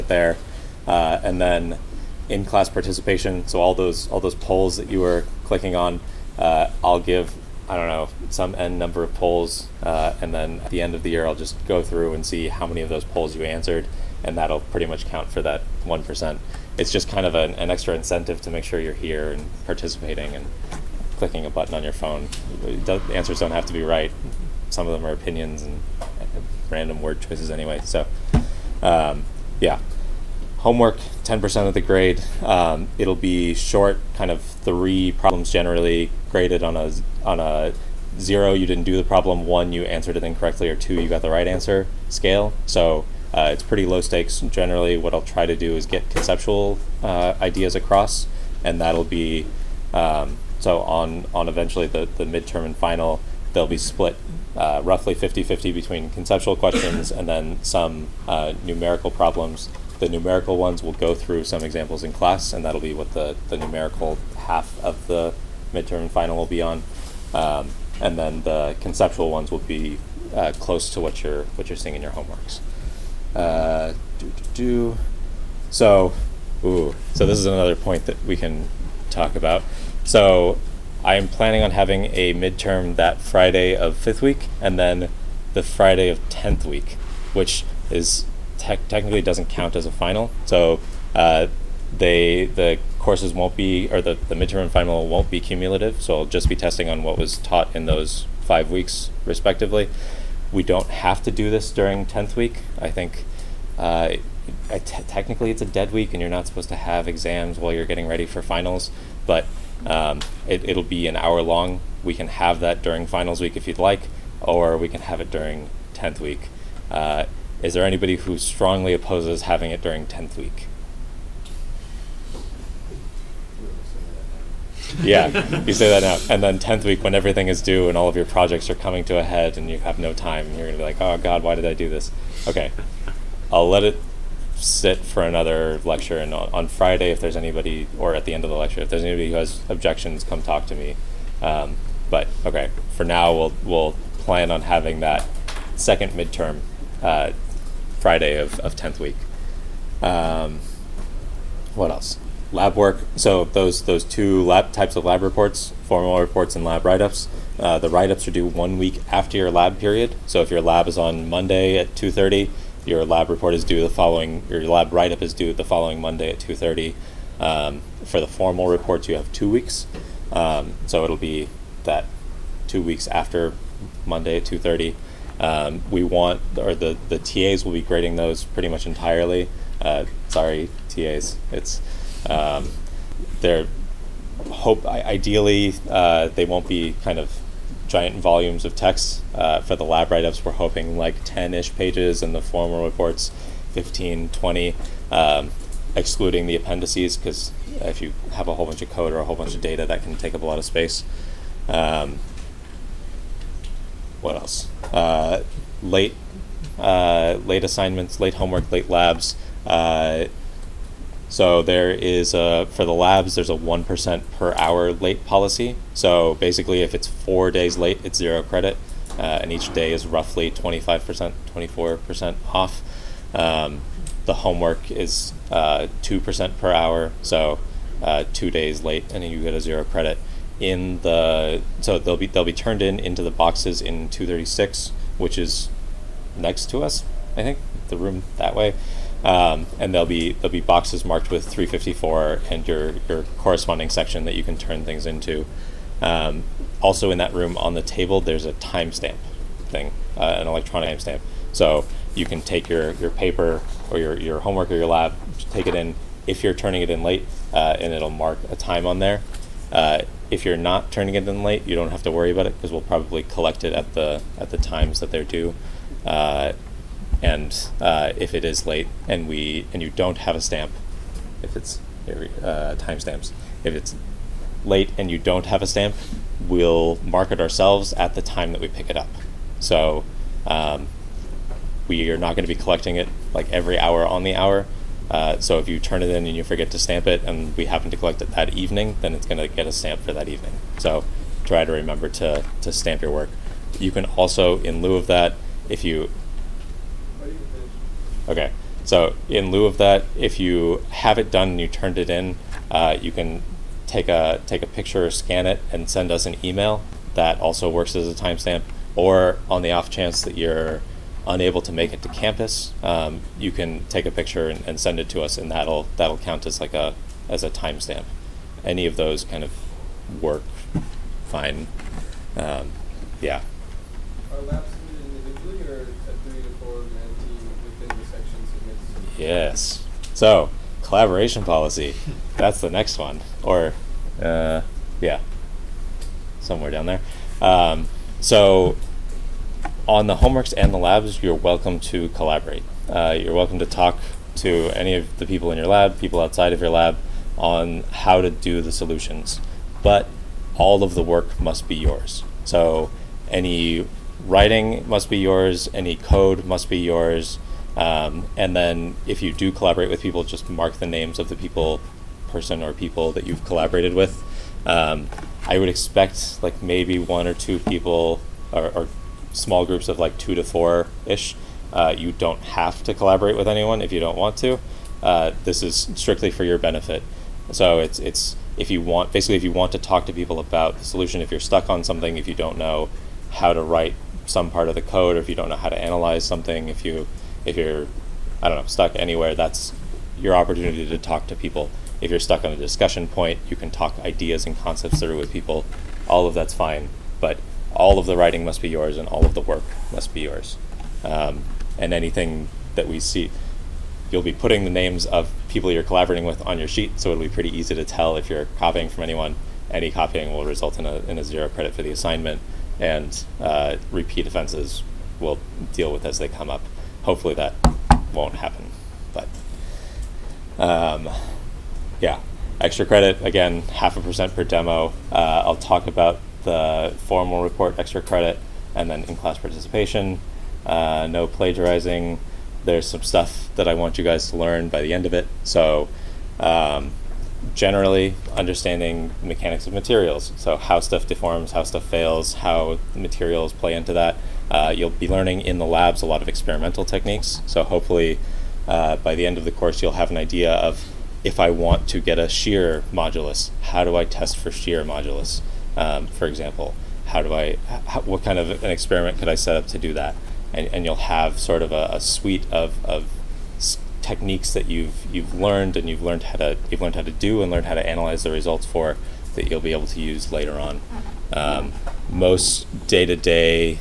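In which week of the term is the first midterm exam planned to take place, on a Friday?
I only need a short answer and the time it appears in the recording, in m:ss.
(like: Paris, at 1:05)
fifth week, at 1:23.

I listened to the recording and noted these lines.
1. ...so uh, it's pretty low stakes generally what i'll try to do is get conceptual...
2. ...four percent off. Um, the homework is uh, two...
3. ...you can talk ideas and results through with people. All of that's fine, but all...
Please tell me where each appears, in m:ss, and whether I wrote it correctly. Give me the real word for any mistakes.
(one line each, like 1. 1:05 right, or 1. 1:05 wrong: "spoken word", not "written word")
1. 0:42 right
2. 3:41 right
3. 6:33 wrong: "concepts", not "results".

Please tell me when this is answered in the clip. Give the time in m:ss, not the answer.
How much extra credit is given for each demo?
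7:03.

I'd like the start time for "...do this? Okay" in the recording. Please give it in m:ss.
2:11.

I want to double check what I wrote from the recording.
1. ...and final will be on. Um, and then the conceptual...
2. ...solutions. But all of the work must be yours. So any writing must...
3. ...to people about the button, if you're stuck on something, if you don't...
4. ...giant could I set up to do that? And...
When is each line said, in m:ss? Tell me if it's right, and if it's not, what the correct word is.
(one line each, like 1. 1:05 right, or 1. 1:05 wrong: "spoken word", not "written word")
1. 1:06 right
2. 5:48 right
3. 6:20 wrong: "solution", not "button"
4. 7:38 wrong: "experiment", not "giant".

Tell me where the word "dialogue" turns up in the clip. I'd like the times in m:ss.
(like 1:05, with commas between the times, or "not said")
not said.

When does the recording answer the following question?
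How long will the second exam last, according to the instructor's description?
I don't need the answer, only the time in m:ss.
1:51.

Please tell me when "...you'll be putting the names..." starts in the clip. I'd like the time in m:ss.
6:44.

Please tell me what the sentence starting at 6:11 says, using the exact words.
Uh, you don't have to collaborate with anyone if you don't want to.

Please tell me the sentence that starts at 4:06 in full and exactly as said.
Um, also in that room on the table, there's a timestamp thing, uh, an electronic timestamp.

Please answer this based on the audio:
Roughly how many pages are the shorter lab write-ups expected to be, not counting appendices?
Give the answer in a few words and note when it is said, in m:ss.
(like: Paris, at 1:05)
10, at 3:11.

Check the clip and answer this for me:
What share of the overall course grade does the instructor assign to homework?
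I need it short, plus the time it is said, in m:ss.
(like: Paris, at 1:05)
10%, at 0:31.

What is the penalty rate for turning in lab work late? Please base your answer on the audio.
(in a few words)
1% per hour.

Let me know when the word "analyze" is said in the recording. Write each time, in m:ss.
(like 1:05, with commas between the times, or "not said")
6:25, 7:47.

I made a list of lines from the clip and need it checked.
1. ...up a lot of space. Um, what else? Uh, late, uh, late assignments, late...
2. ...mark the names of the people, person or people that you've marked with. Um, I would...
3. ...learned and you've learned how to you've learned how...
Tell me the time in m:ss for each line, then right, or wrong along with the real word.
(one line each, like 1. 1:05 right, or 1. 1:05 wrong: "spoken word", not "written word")
1. 3:20 right
2. 6:00 wrong: "collaborated", not "marked"
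3. 7:45 right.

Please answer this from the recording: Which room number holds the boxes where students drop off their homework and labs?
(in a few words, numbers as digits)
236.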